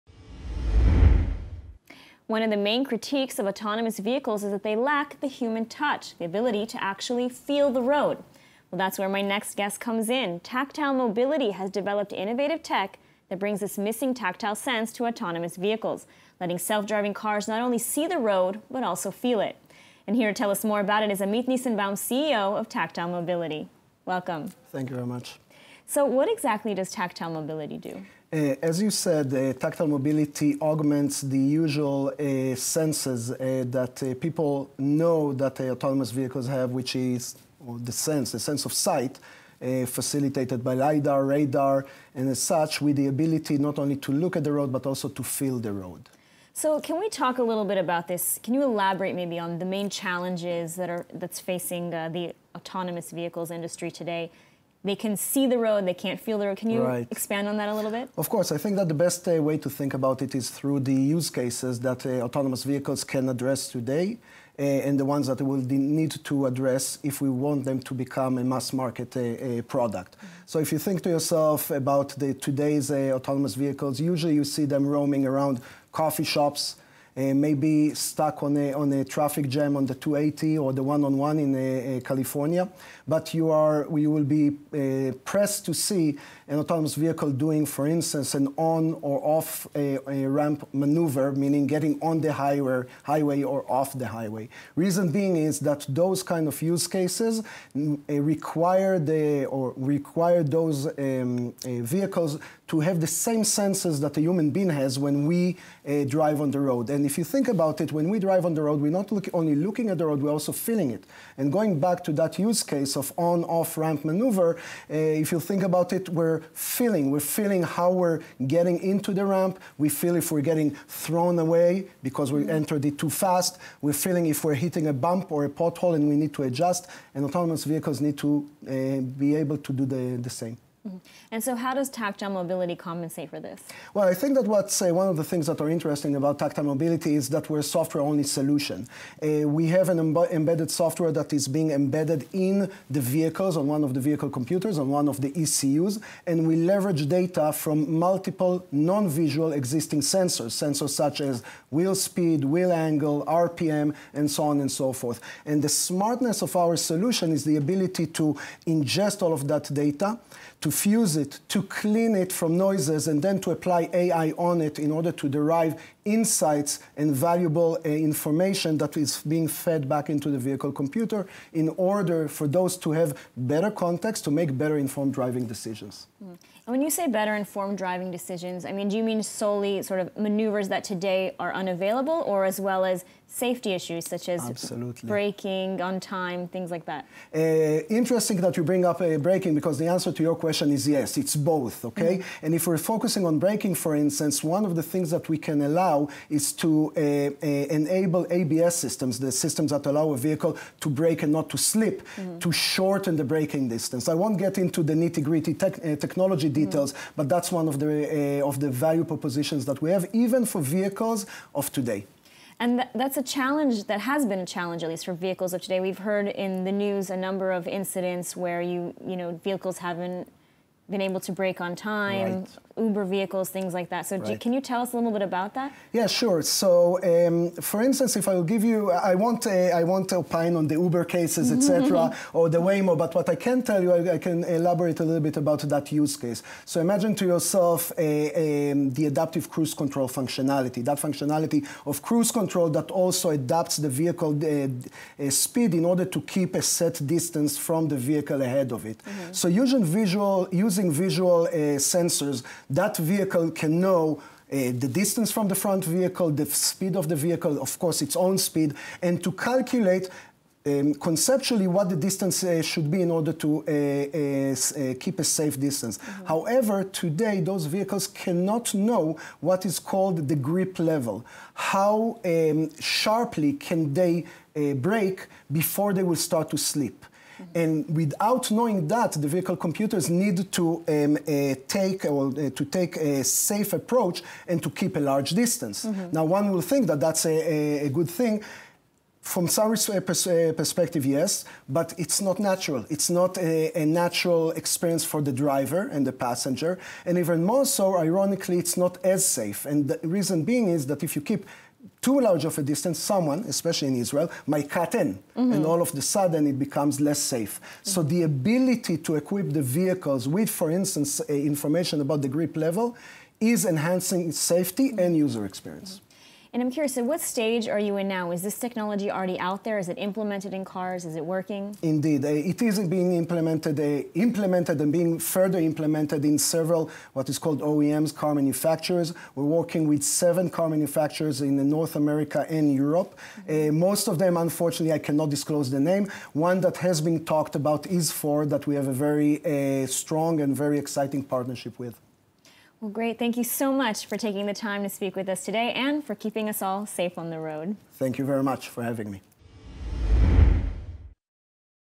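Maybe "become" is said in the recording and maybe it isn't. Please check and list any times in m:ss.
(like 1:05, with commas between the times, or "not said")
1:07, 5:06.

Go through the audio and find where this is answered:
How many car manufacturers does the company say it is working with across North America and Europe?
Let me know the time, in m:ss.
5:30.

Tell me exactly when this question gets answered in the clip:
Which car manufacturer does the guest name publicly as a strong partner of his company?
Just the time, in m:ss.
5:38.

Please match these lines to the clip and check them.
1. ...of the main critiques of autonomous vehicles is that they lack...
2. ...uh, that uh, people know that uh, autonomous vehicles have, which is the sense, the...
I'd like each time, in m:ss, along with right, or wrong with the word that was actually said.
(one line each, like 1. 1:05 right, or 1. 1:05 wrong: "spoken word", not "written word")
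1. 0:02 right
2. 0:33 right.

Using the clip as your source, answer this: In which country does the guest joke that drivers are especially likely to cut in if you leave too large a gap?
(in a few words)
Israel.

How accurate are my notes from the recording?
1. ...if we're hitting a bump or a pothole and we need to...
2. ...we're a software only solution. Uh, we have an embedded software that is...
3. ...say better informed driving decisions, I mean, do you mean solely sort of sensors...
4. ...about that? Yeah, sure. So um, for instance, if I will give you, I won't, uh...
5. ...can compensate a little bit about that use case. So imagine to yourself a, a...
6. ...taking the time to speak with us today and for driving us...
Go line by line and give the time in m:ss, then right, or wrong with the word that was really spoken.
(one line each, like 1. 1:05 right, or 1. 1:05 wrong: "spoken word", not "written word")
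1. 2:04 right
2. 2:17 right
3. 2:56 wrong: "maneuvers", not "sensors"
4. 3:45 right
5. 3:54 wrong: "elaborate", not "compensate"
6. 5:44 wrong: "keeping", not "driving".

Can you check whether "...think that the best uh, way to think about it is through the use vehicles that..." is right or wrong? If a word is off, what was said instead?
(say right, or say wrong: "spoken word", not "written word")
wrong: "cases", not "vehicles".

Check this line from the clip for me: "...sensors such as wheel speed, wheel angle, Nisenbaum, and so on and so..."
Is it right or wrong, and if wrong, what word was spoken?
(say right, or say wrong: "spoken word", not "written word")
wrong: "RPM", not "Nisenbaum".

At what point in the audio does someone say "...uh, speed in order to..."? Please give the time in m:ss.
4:05.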